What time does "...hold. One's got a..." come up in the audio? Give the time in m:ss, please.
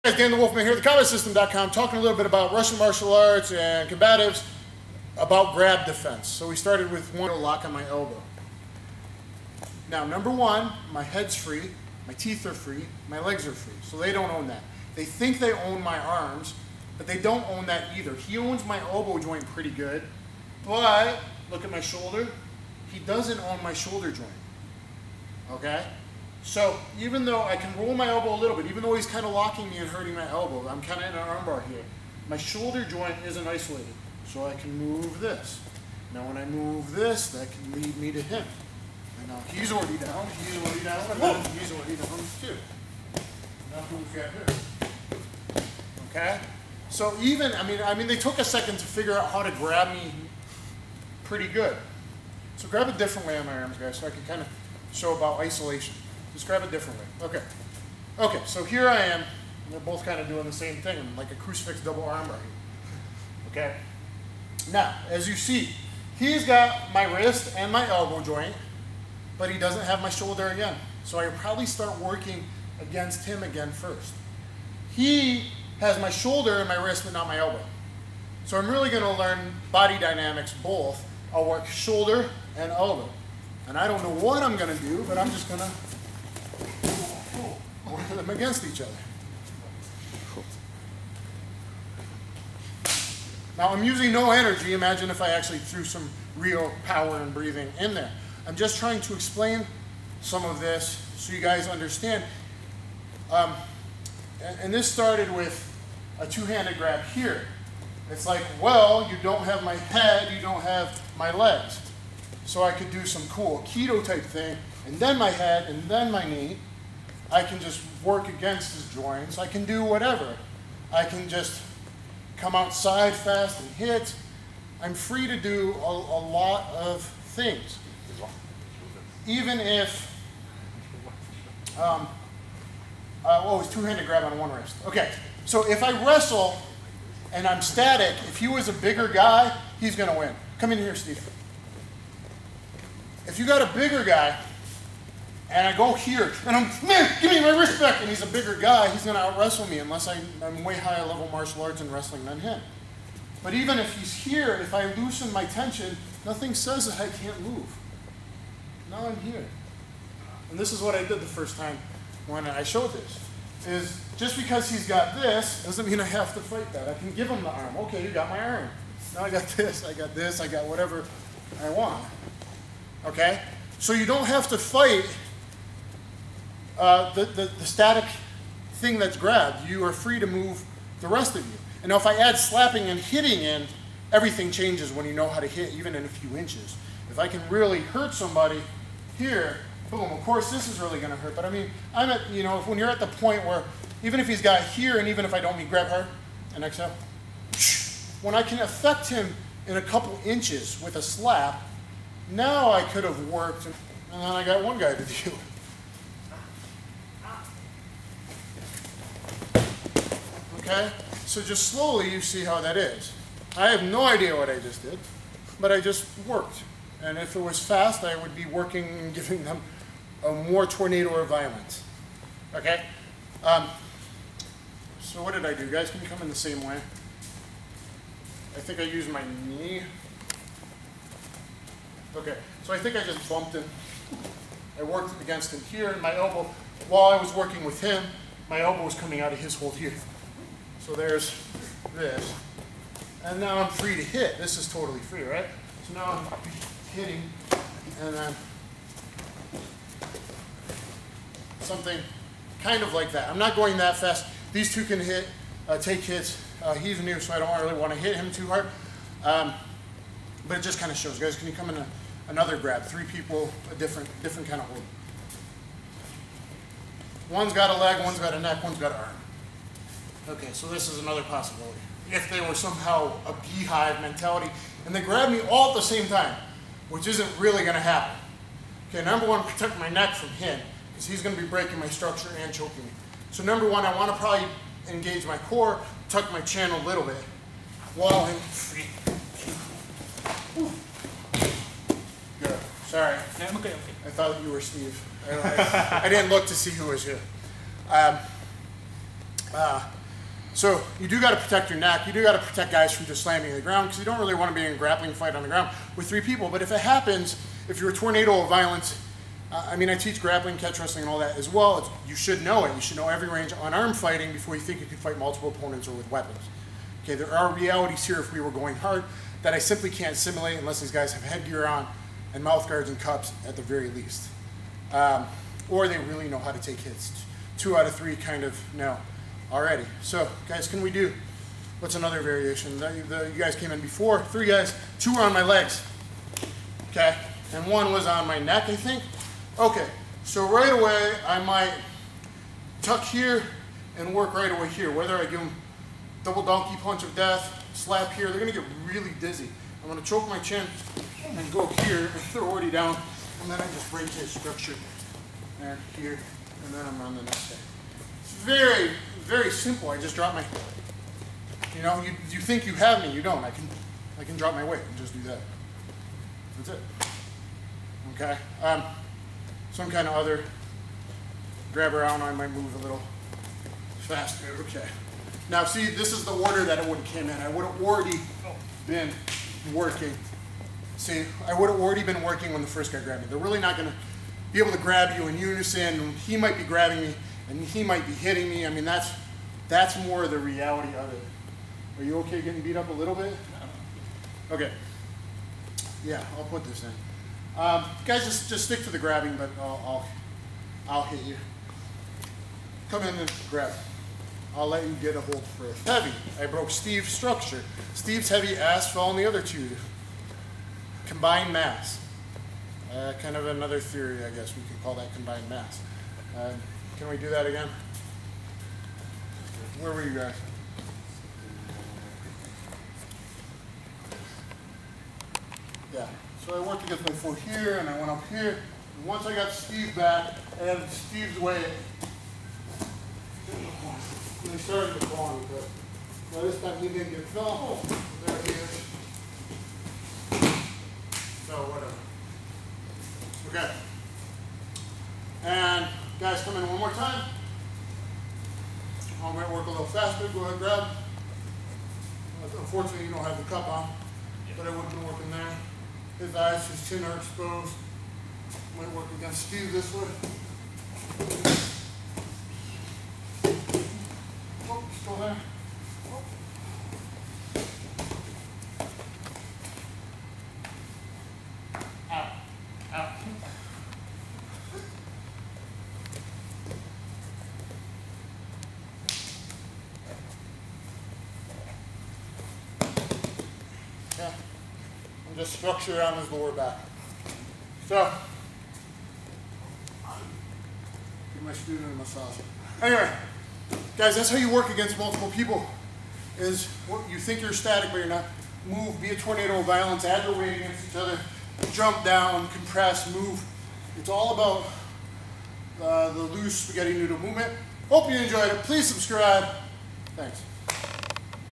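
4:24.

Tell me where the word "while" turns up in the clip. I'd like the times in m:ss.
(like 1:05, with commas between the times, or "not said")
3:56, 4:47.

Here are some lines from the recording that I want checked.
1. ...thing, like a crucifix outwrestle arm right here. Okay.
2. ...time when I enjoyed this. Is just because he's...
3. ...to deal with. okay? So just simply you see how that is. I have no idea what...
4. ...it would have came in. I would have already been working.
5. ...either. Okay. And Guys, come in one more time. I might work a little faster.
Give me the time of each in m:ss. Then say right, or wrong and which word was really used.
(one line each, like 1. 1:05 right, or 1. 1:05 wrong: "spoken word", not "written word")
1. 1:00 wrong: "double", not "outwrestle"
2. 2:41 wrong: "showed", not "enjoyed"
3. 3:24 wrong: "slowly", not "simply"
4. 6:16 right
5. 7:21 wrong: "whatever", not "either".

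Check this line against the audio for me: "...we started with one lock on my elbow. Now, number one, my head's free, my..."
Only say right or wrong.
right.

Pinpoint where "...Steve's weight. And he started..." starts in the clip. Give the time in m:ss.
7:10.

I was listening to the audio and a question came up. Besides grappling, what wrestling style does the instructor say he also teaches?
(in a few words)
Catch wrestling.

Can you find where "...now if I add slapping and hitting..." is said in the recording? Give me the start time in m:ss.
3:01.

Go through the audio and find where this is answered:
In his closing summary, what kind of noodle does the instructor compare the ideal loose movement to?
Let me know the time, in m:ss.
8:26.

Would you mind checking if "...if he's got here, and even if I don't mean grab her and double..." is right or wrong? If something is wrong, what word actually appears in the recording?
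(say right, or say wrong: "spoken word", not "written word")
wrong: "exhale", not "double".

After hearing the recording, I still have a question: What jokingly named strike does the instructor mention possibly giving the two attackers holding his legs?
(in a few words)
Double donkey punch of death.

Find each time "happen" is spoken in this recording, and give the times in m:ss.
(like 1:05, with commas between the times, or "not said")
4:37, 5:06.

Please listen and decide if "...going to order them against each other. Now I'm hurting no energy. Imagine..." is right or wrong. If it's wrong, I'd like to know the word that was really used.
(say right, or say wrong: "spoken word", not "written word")
wrong: "using", not "hurting".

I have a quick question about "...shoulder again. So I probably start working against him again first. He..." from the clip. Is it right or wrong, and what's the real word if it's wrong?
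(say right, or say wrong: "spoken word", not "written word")
right.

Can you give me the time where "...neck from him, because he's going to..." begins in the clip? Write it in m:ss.
4:39.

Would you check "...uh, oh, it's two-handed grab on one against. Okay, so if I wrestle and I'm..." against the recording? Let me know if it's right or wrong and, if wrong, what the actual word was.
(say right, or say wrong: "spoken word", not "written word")
wrong: "wrist", not "against".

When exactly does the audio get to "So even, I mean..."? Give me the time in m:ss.
0:46.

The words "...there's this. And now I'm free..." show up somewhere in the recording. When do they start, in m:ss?
4:00.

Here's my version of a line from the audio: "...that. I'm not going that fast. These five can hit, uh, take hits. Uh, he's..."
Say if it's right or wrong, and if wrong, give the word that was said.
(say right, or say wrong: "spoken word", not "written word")
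wrong: "two", not "five".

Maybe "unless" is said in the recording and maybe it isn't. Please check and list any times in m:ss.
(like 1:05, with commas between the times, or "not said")
2:29, 5:20.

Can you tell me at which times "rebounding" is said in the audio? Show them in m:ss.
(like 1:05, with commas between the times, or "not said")
not said.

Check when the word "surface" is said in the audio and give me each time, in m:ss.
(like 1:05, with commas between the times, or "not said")
not said.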